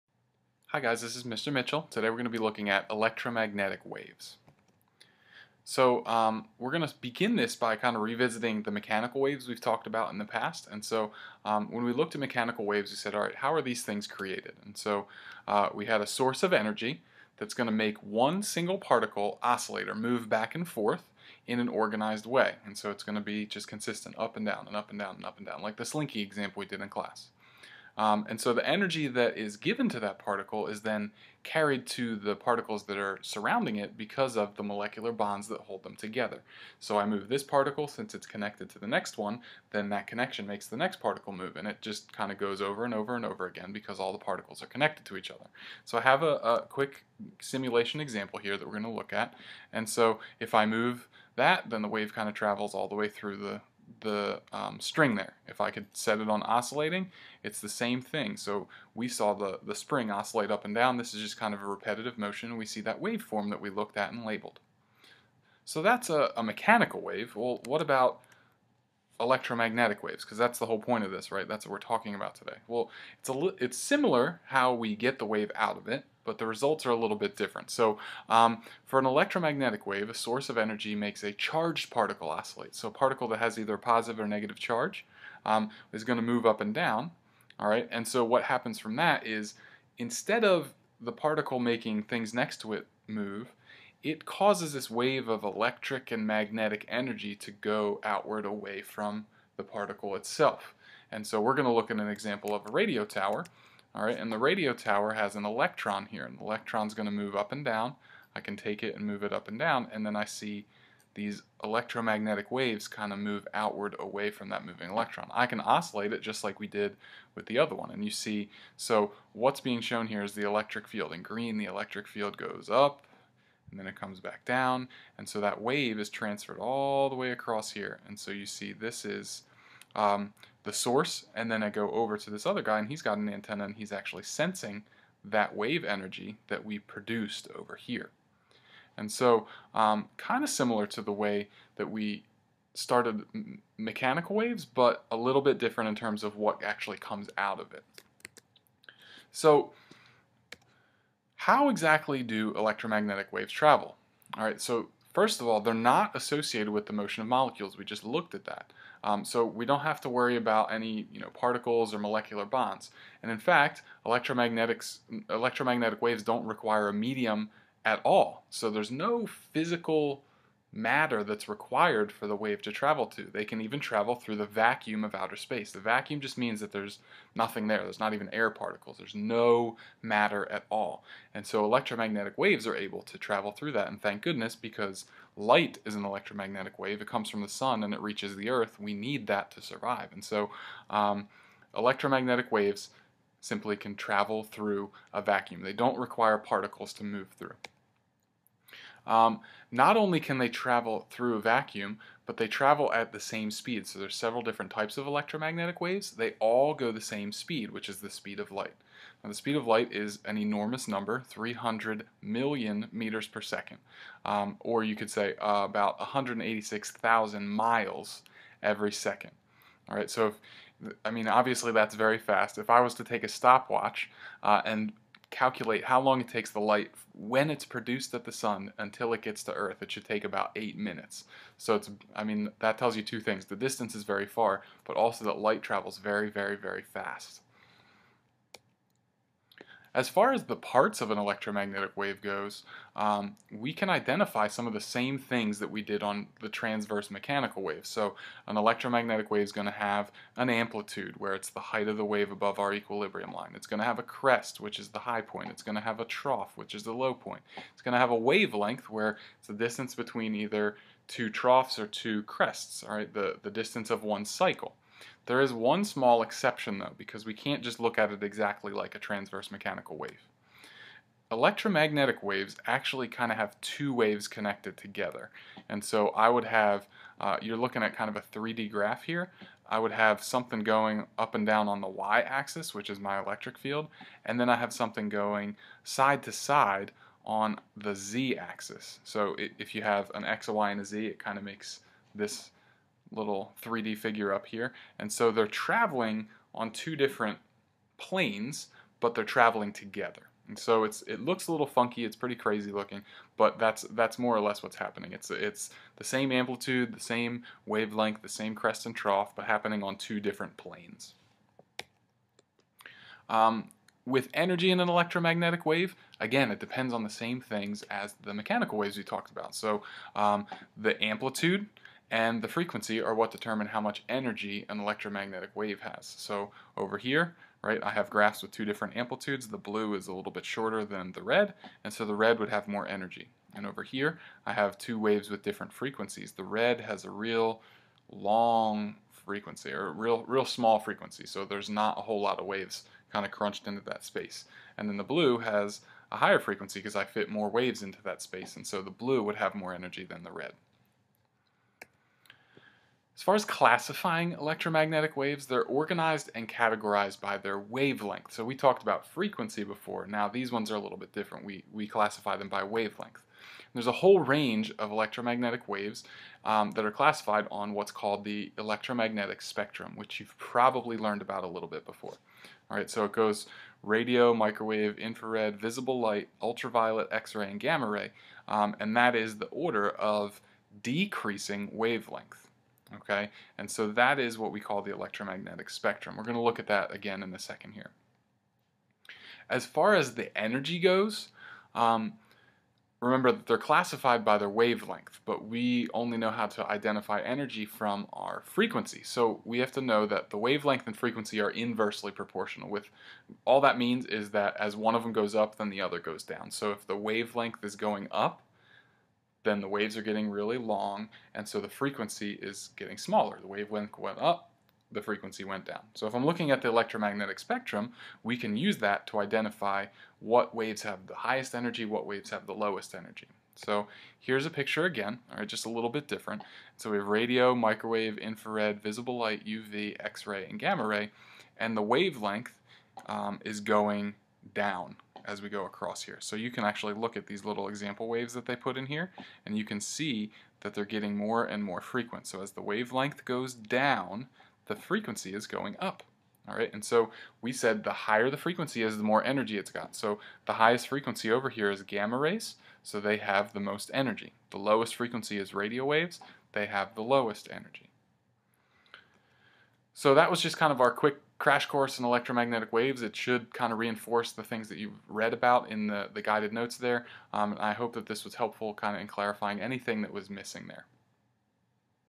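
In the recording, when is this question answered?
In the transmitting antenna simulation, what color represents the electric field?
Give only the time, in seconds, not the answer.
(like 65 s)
121 s.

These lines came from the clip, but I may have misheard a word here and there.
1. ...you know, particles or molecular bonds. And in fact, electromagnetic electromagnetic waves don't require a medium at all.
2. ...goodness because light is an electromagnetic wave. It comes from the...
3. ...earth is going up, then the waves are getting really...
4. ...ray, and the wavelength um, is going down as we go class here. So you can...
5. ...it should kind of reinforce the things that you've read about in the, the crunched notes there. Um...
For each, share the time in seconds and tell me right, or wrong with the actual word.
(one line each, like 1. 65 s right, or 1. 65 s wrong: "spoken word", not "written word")
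1. 161 s right
2. 184 s right
3. 406 s wrong: "wavelength", not "earth"
4. 430 s wrong: "across", not "class"
5. 463 s wrong: "guided", not "crunched".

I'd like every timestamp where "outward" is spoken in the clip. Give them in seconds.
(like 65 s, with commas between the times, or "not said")
98 s, 113 s.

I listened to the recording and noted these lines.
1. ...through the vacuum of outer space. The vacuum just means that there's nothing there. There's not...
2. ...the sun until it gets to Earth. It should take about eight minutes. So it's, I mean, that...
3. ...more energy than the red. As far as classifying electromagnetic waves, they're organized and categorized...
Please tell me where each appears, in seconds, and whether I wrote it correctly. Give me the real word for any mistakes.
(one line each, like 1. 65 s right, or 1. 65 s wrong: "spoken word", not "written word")
1. 174 s right
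2. 228 s right
3. 349 s right.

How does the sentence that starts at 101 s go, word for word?
And so we're going to look at an example of a radio tower.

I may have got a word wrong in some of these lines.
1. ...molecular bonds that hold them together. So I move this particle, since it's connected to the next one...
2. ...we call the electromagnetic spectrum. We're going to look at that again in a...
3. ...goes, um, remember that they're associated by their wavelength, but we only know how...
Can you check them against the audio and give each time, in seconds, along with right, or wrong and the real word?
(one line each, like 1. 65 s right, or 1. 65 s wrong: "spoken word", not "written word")
1. 34 s right
2. 384 s right
3. 390 s wrong: "classified", not "associated".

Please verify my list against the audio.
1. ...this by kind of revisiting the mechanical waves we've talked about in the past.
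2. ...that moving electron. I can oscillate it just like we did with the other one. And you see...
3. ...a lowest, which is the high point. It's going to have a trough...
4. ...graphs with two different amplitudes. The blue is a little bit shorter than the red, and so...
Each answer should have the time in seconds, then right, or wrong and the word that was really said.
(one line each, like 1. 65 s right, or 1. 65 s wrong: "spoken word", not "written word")
1. 7 s right
2. 114 s right
3. 253 s wrong: "crest", not "lowest"
4. 328 s right.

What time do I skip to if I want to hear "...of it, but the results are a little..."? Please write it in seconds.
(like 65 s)
75 s.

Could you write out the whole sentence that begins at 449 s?
So the highest frequency over here is gamma rays, so they have the most energy.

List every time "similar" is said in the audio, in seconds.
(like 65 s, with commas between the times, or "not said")
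73 s, 140 s.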